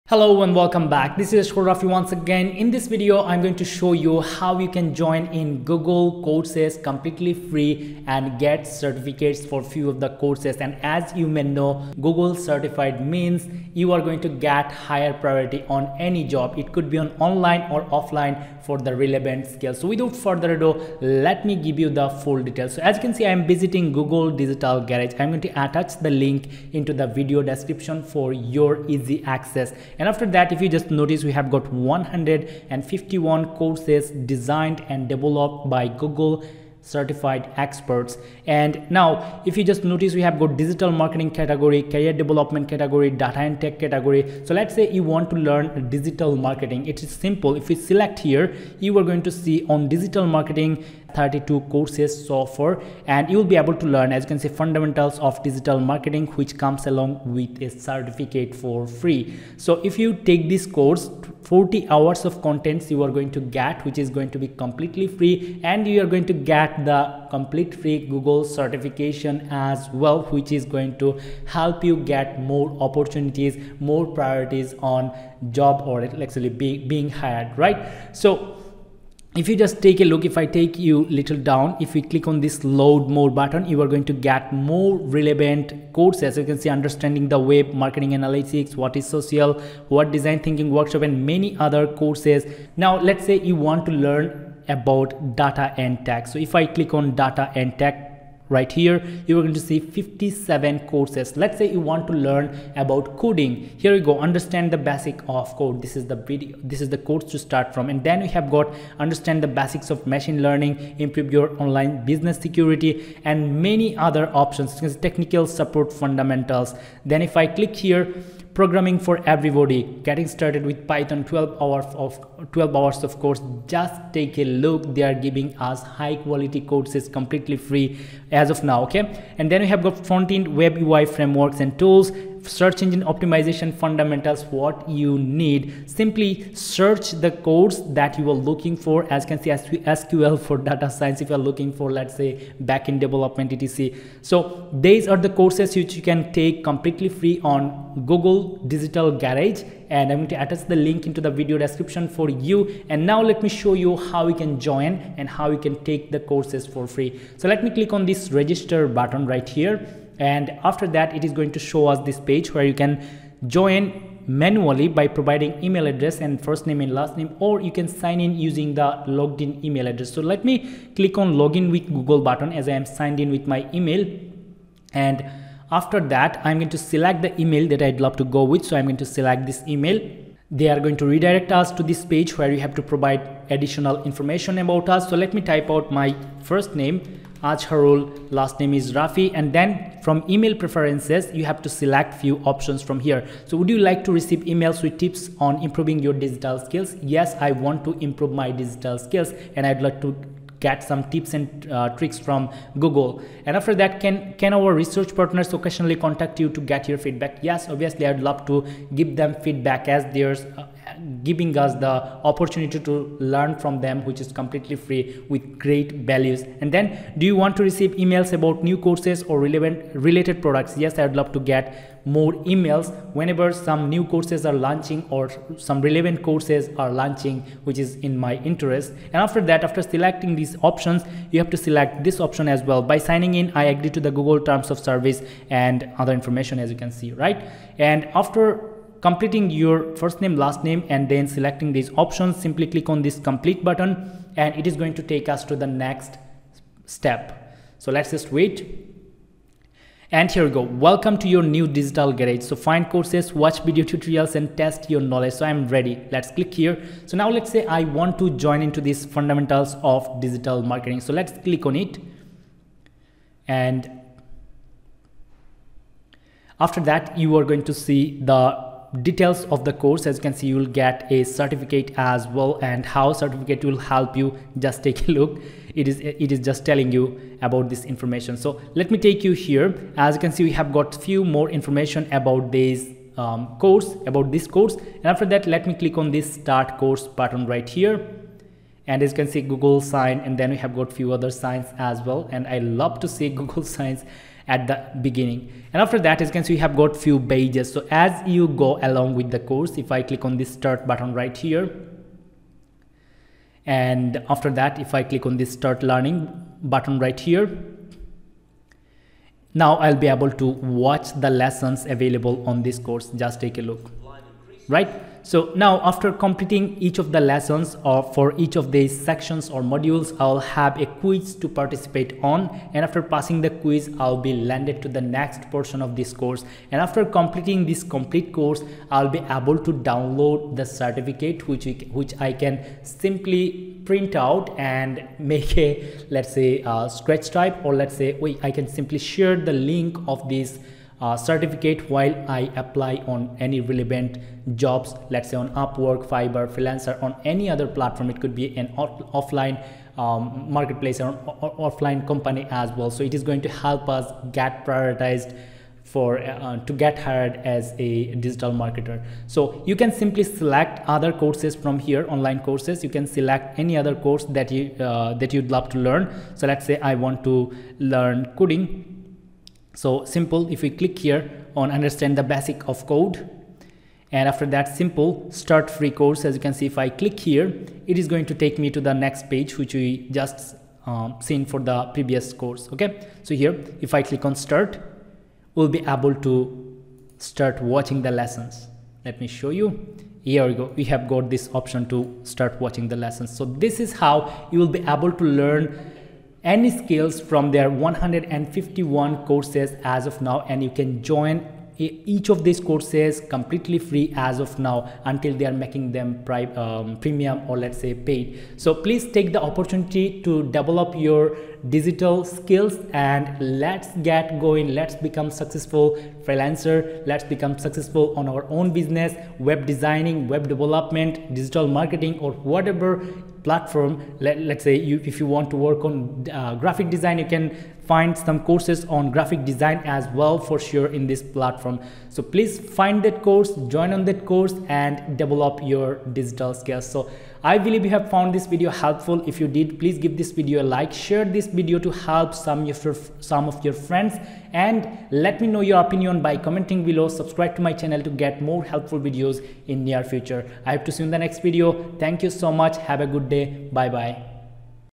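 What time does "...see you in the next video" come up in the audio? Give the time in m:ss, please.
7:30.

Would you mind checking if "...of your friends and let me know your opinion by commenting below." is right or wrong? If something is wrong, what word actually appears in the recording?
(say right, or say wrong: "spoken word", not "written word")
right.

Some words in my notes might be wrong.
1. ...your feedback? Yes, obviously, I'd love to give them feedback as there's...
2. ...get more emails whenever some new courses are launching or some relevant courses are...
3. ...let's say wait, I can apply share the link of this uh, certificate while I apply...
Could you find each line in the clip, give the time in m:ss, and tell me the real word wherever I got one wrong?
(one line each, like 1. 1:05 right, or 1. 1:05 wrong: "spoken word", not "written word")
1. 3:26 right
2. 3:41 right
3. 5:37 wrong: "simply", not "apply".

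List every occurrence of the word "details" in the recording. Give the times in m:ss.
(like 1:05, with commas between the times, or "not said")
0:22, 4:29.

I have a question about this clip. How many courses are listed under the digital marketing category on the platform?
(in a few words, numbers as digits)
32.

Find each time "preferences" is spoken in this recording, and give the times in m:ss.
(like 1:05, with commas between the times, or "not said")
3:10.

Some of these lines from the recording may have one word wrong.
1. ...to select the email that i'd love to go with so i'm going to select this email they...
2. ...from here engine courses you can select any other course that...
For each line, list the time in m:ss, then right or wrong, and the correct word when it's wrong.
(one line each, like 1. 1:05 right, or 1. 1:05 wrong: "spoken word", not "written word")
1. 2:56 right
2. 6:01 wrong: "online", not "engine".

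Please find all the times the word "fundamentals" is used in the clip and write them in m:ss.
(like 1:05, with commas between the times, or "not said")
0:54, 1:56, 2:13, 4:19.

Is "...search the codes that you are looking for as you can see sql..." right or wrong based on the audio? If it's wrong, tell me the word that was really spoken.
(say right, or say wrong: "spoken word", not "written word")
right.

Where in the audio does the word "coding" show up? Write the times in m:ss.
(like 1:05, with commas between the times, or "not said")
1:43, 6:08.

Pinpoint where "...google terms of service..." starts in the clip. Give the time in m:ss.
3:54.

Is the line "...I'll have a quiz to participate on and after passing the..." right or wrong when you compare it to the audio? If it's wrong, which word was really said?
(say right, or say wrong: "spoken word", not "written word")
right.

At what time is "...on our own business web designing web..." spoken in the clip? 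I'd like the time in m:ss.
6:58.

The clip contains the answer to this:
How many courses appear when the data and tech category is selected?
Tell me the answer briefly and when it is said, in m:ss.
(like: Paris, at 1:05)
57, at 1:39.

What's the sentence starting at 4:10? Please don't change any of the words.
Welcome to your new digital garage.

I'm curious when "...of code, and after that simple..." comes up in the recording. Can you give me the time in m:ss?
6:12.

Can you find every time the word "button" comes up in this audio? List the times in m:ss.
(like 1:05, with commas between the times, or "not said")
1:23, 2:38, 2:52, 4:03, 4:47, 5:00, 5:06.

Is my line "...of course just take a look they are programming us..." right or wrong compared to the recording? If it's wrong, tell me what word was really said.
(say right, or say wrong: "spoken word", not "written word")
wrong: "giving", not "programming".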